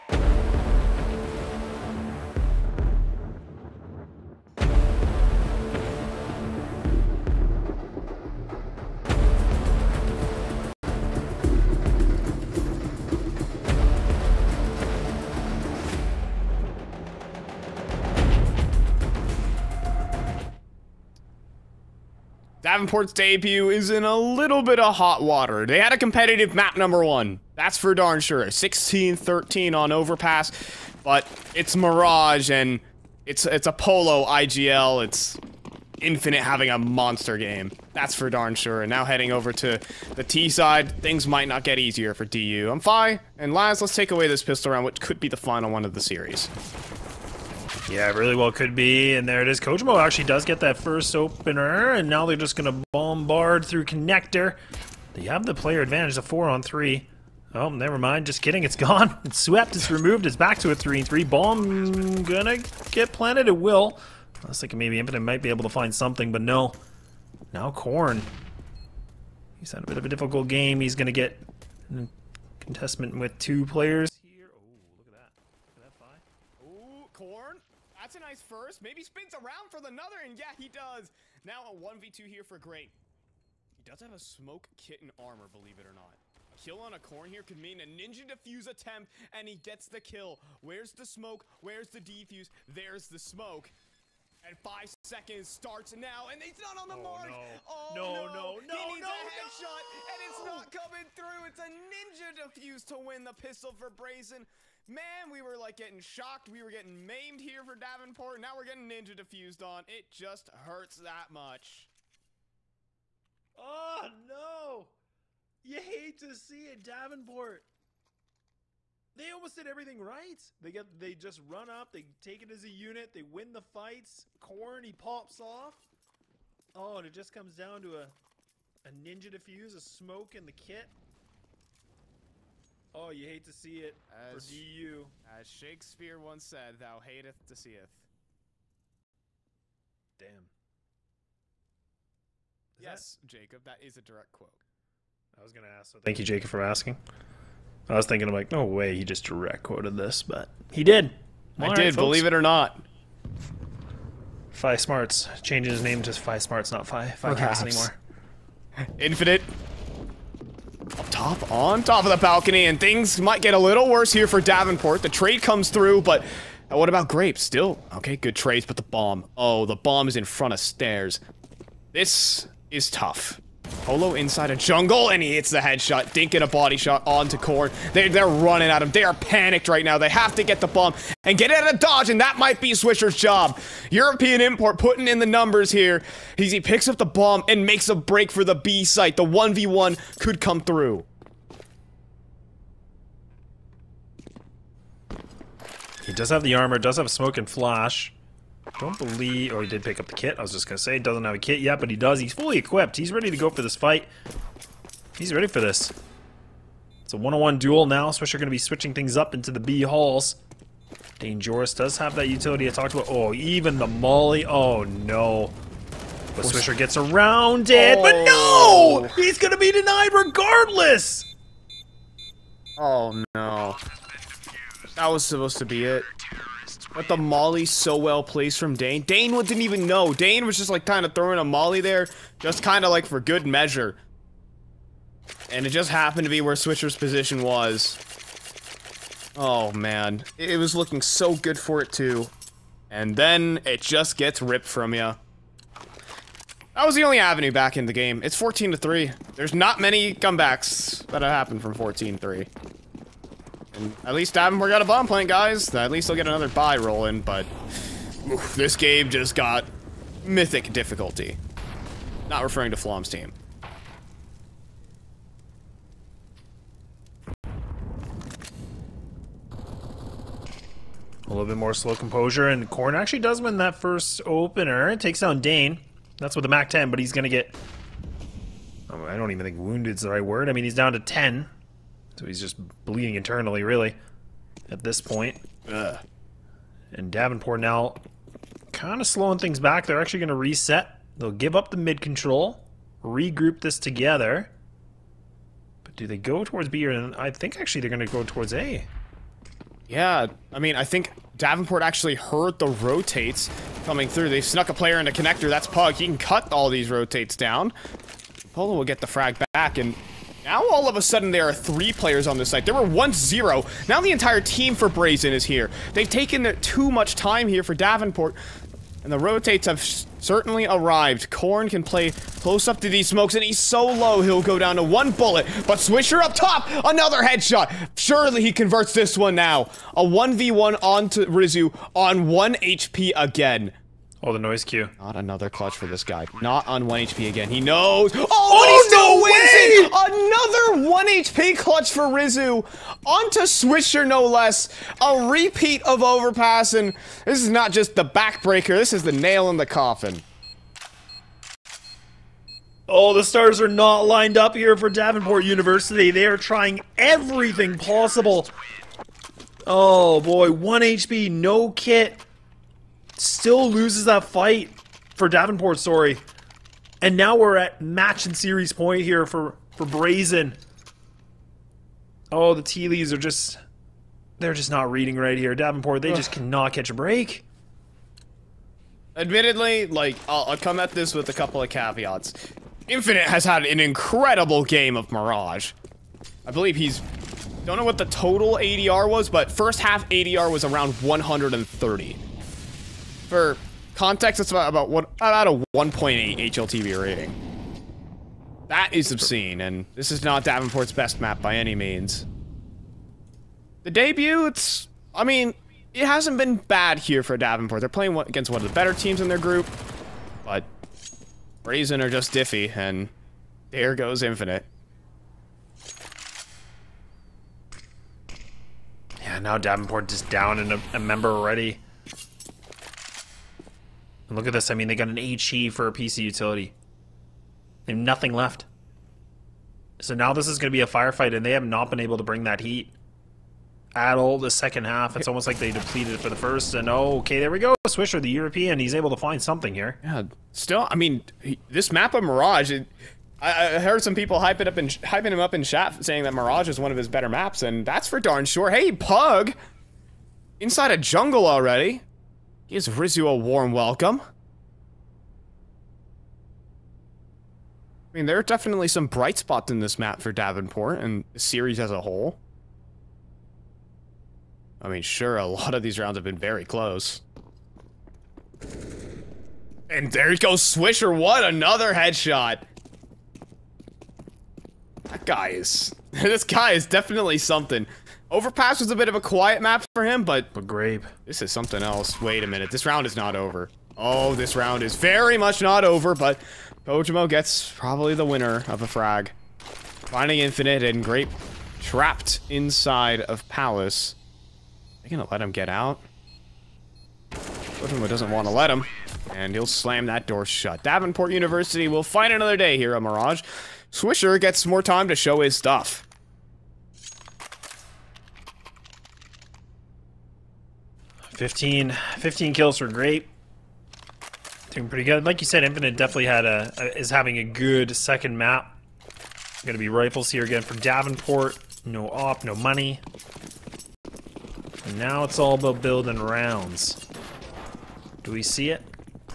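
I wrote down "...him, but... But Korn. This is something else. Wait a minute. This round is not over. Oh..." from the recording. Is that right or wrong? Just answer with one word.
wrong.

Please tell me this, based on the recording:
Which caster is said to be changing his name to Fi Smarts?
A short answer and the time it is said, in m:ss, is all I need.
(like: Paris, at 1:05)
Fi Cast, at 2:37.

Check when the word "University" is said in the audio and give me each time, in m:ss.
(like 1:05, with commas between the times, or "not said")
5:55, 8:21.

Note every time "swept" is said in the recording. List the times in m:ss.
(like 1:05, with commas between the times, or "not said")
0:59.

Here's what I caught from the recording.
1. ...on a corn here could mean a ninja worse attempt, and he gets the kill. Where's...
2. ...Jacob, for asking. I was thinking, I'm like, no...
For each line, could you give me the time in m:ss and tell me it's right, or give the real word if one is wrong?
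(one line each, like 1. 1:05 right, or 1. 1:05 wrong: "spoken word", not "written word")
1. 1:26 wrong: "defuse", not "worse"
2. 2:26 right.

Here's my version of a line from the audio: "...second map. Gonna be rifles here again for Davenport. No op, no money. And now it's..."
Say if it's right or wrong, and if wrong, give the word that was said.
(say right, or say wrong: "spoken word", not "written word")
right.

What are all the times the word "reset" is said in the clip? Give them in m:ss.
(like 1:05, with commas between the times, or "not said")
4:50.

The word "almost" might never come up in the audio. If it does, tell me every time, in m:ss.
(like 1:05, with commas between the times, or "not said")
1:59, 7:15.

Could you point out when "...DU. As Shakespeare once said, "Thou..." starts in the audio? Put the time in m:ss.
2:14.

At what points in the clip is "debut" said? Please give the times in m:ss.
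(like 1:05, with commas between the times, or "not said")
0:23, 6:43.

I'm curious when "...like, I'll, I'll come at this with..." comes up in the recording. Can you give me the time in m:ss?
6:19.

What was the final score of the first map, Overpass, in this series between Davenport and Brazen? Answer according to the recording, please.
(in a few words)
16-13.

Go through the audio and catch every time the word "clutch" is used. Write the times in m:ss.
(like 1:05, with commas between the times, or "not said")
5:35, 5:41.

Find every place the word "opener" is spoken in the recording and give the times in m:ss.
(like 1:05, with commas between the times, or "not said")
0:51, 4:34.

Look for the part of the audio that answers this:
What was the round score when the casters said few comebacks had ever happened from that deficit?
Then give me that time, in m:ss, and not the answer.
4:08.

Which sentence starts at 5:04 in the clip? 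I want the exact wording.
They snuck a player in a connector.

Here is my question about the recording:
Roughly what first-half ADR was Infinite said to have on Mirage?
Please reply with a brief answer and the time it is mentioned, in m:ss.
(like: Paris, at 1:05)
130, at 6:31.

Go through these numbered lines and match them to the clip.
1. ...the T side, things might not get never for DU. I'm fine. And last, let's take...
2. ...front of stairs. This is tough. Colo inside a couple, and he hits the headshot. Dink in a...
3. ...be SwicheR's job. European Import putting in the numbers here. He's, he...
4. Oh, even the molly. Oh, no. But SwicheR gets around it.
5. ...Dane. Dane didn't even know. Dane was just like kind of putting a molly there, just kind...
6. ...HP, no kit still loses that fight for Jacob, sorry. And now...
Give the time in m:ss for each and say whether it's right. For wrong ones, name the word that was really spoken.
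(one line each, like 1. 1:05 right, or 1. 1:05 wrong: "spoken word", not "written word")
1. 0:40 wrong: "easier", not "never"
2. 2:50 wrong: "jungle", not "couple"
3. 3:02 right
4. 3:33 right
5. 3:48 wrong: "throwing", not "putting"
6. 6:00 wrong: "Davenport", not "Jacob".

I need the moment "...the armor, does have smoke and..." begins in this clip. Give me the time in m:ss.
3:16.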